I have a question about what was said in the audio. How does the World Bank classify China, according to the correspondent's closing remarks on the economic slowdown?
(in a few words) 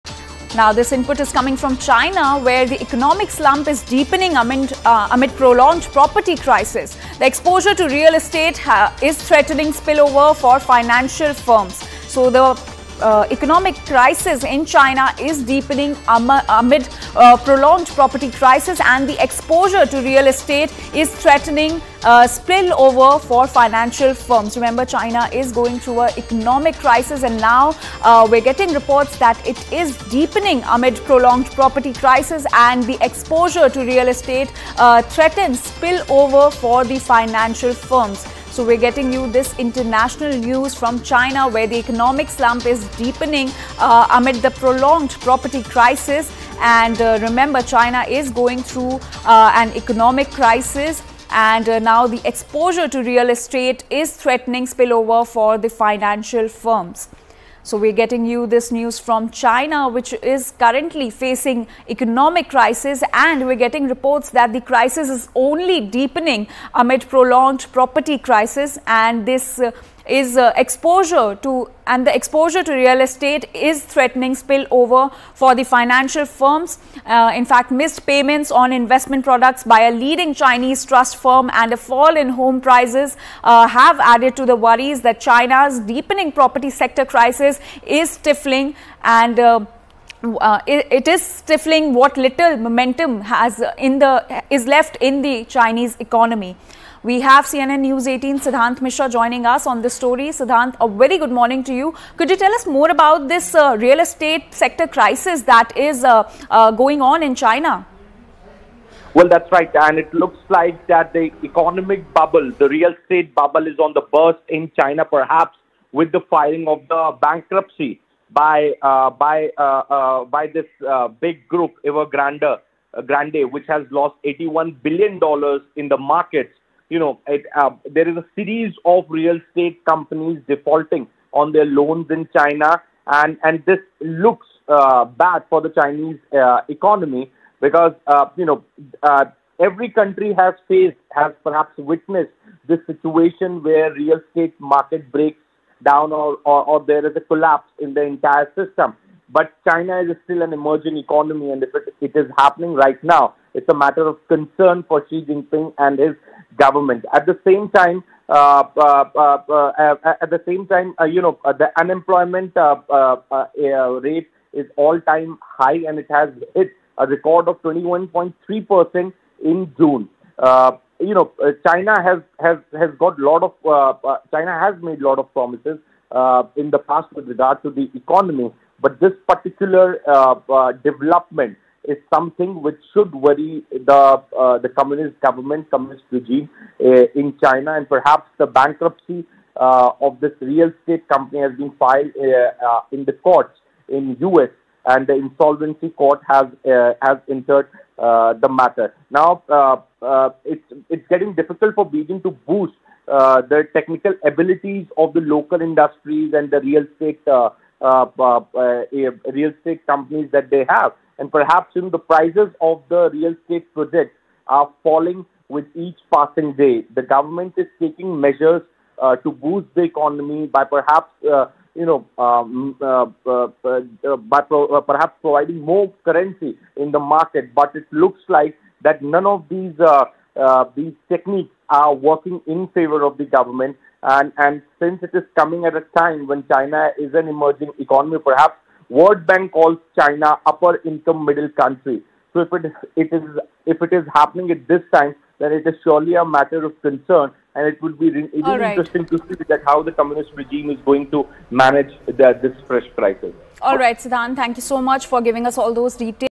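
upper income middle country.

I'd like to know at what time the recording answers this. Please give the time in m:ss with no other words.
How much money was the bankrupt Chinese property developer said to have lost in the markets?
2:04.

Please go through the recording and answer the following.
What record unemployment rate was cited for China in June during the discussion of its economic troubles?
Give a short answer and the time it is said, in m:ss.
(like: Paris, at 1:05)
21.3 percent, at 2:47.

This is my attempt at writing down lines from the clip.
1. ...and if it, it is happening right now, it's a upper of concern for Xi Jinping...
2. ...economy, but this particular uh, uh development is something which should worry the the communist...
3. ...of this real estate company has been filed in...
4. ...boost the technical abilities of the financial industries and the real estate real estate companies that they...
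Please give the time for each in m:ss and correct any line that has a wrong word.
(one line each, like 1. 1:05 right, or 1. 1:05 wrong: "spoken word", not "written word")
1. 2:31 wrong: "matter", not "upper"
2. 2:57 right
3. 3:09 right
4. 3:22 wrong: "local", not "financial".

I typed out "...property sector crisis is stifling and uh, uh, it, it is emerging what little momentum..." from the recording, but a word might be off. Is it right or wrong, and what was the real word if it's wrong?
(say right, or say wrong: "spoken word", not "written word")
wrong: "stifling", not "emerging".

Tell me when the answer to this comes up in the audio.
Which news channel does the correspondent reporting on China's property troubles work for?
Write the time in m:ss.
1:37.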